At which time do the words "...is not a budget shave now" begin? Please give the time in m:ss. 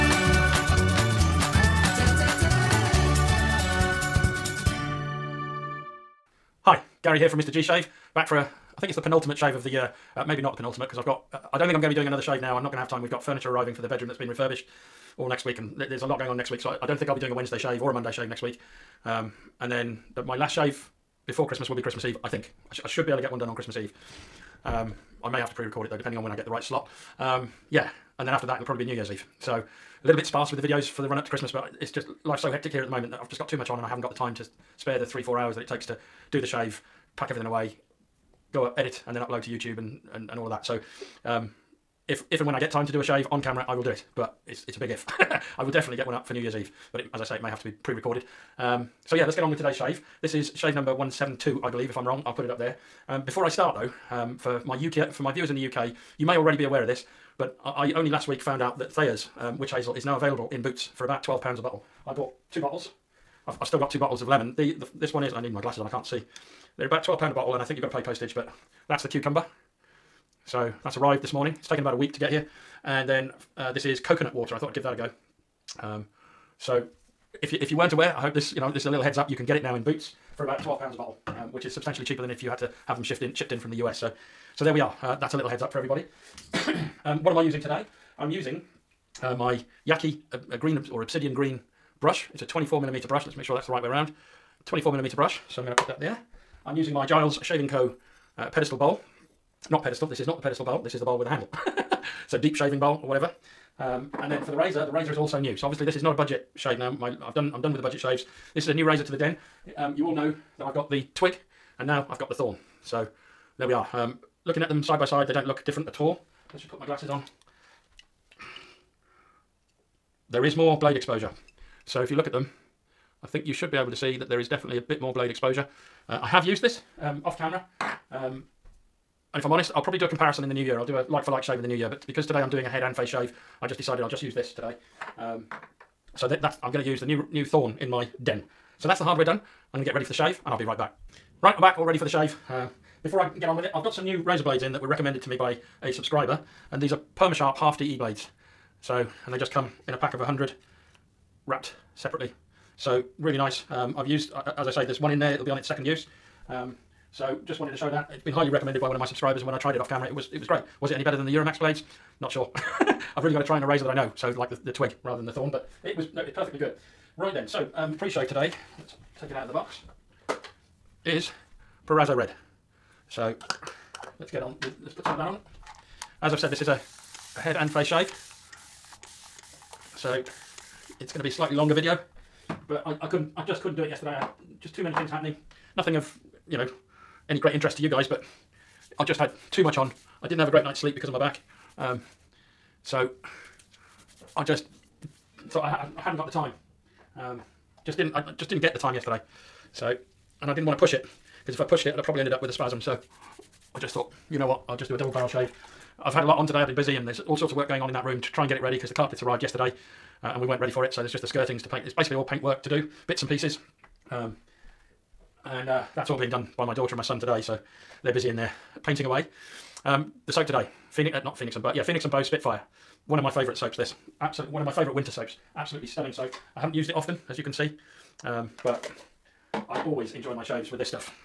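1:45.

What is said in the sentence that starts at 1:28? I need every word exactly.
I'm using uh, my Yaqi a, a, green or obsidian green brush.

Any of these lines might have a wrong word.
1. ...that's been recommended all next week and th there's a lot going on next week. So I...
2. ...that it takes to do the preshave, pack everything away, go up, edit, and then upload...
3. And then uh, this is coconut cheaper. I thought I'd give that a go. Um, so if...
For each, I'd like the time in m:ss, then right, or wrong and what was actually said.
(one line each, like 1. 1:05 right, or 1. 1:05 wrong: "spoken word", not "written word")
1. 0:14 wrong: "refurbished", not "recommended"
2. 0:35 wrong: "shave", not "preshave"
3. 1:12 wrong: "water", not "cheaper".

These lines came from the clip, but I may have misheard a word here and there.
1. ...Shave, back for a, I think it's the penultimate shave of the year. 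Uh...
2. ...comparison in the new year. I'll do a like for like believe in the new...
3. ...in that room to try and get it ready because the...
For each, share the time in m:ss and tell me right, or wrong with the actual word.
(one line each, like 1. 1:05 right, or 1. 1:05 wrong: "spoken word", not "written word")
1. 0:07 right
2. 2:10 wrong: "shave", not "believe"
3. 3:27 right.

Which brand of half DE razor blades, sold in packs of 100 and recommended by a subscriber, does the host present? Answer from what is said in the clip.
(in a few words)
PermaSharp.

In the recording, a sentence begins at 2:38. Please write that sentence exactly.
It's been highly recommended by one of my subscribers and when I tried it off camera, it was, it was great.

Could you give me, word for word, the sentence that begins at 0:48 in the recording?
Um, so yeah, let's get on with today's shave.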